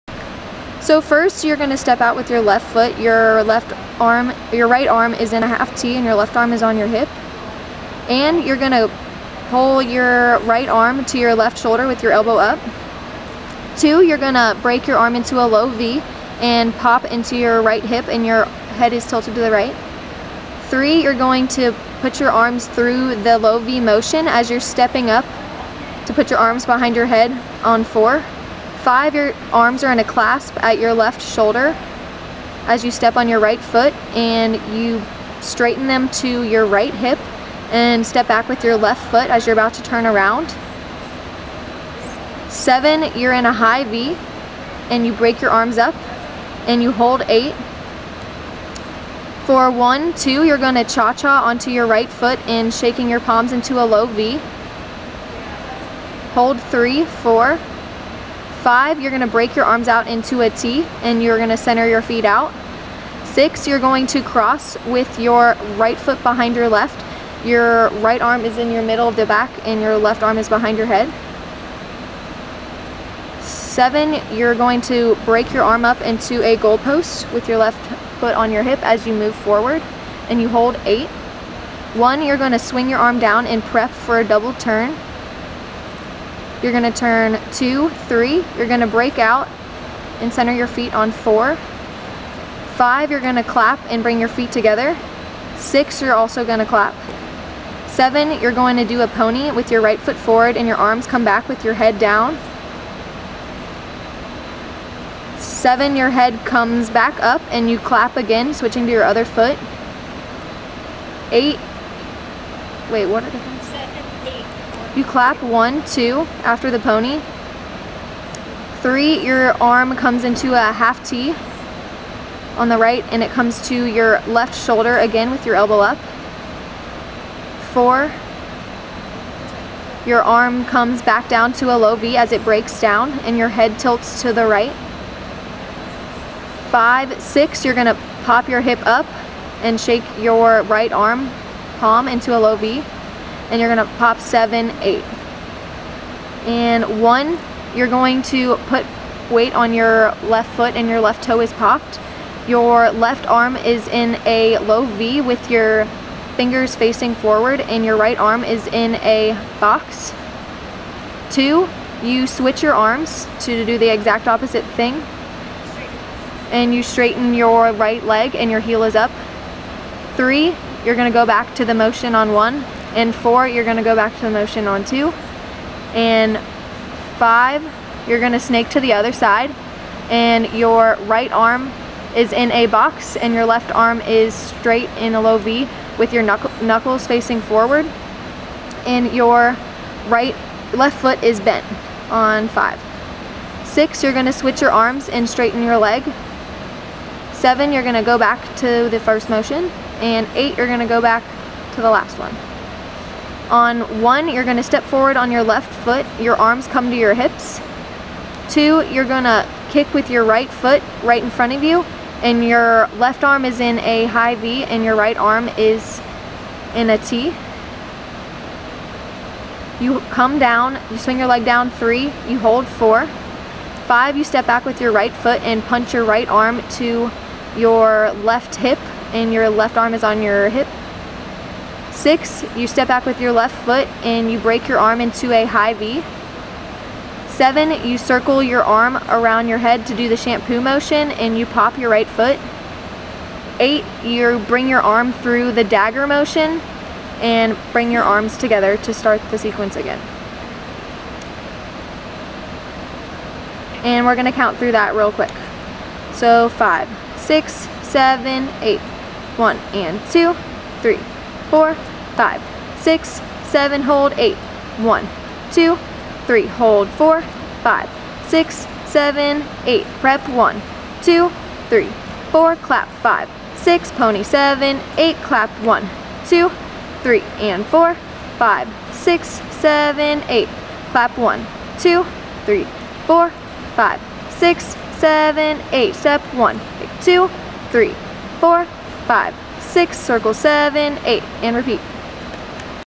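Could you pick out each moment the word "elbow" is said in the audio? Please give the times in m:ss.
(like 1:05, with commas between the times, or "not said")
0:12, 2:05.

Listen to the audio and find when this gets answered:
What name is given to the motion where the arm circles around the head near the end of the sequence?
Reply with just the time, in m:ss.
4:00.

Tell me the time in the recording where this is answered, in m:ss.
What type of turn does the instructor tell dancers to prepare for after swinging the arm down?
1:24.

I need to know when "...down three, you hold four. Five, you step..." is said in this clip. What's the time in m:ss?
3:41.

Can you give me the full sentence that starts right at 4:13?
And we're gonna count through that real quick.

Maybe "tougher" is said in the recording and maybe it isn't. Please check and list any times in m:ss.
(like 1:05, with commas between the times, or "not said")
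not said.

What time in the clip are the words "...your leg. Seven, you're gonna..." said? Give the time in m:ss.
3:15.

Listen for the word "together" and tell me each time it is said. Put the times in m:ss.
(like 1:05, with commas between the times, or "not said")
1:34, 4:08.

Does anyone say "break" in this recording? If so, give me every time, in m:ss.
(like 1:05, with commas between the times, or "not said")
0:14, 0:45, 0:59, 1:15, 1:28, 2:12, 3:54.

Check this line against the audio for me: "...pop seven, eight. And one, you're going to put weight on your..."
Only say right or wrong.
right.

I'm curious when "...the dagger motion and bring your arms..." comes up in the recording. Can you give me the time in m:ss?
4:05.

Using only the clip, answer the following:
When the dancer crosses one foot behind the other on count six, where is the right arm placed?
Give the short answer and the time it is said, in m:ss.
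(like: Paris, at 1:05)
Middle of the back, at 1:08.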